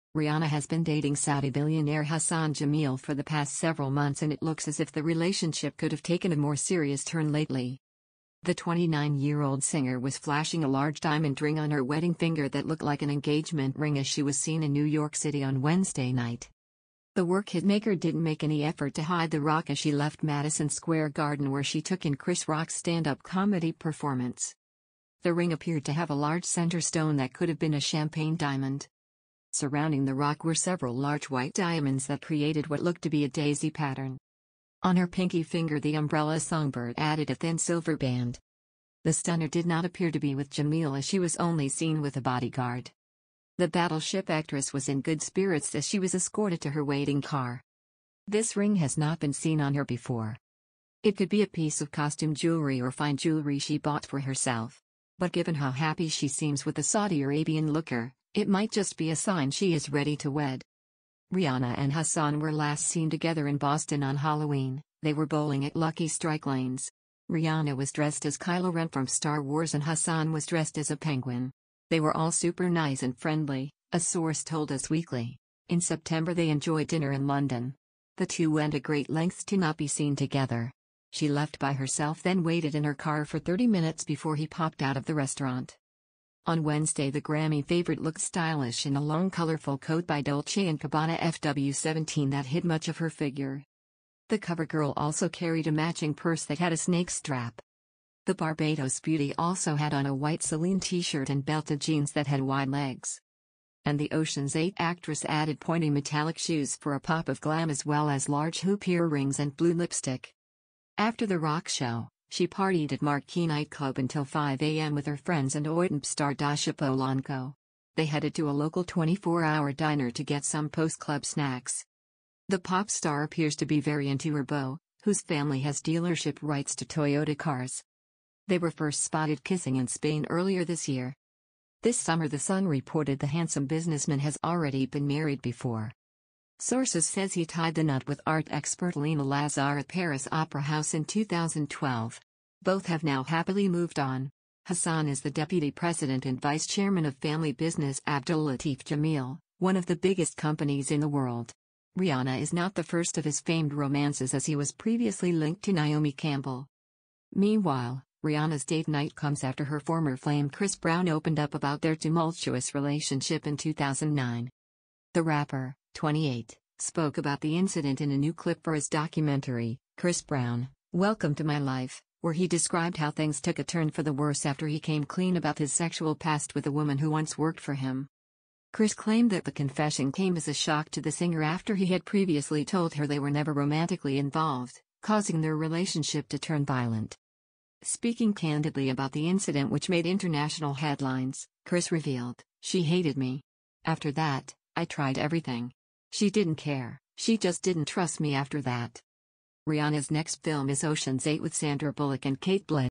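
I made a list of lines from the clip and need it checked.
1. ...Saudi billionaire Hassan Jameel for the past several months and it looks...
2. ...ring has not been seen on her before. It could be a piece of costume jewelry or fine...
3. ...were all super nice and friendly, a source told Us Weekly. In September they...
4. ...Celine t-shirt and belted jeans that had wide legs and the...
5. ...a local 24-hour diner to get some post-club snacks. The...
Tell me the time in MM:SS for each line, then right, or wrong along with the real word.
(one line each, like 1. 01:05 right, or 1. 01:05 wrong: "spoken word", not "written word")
1. 00:01 right
2. 00:48 right
3. 01:11 right
4. 01:40 right
5. 01:58 right.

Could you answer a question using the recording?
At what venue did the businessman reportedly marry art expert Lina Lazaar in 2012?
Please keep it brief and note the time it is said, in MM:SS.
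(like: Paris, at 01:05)
Paris Opera House, at 02:19.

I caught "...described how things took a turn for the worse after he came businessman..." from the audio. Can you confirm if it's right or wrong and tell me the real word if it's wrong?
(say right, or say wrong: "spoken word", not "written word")
wrong: "clean", not "businessman".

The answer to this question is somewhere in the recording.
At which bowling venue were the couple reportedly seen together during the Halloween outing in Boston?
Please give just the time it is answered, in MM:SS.
01:05.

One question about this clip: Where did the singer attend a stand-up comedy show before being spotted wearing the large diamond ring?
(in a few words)
Madison Square Garden.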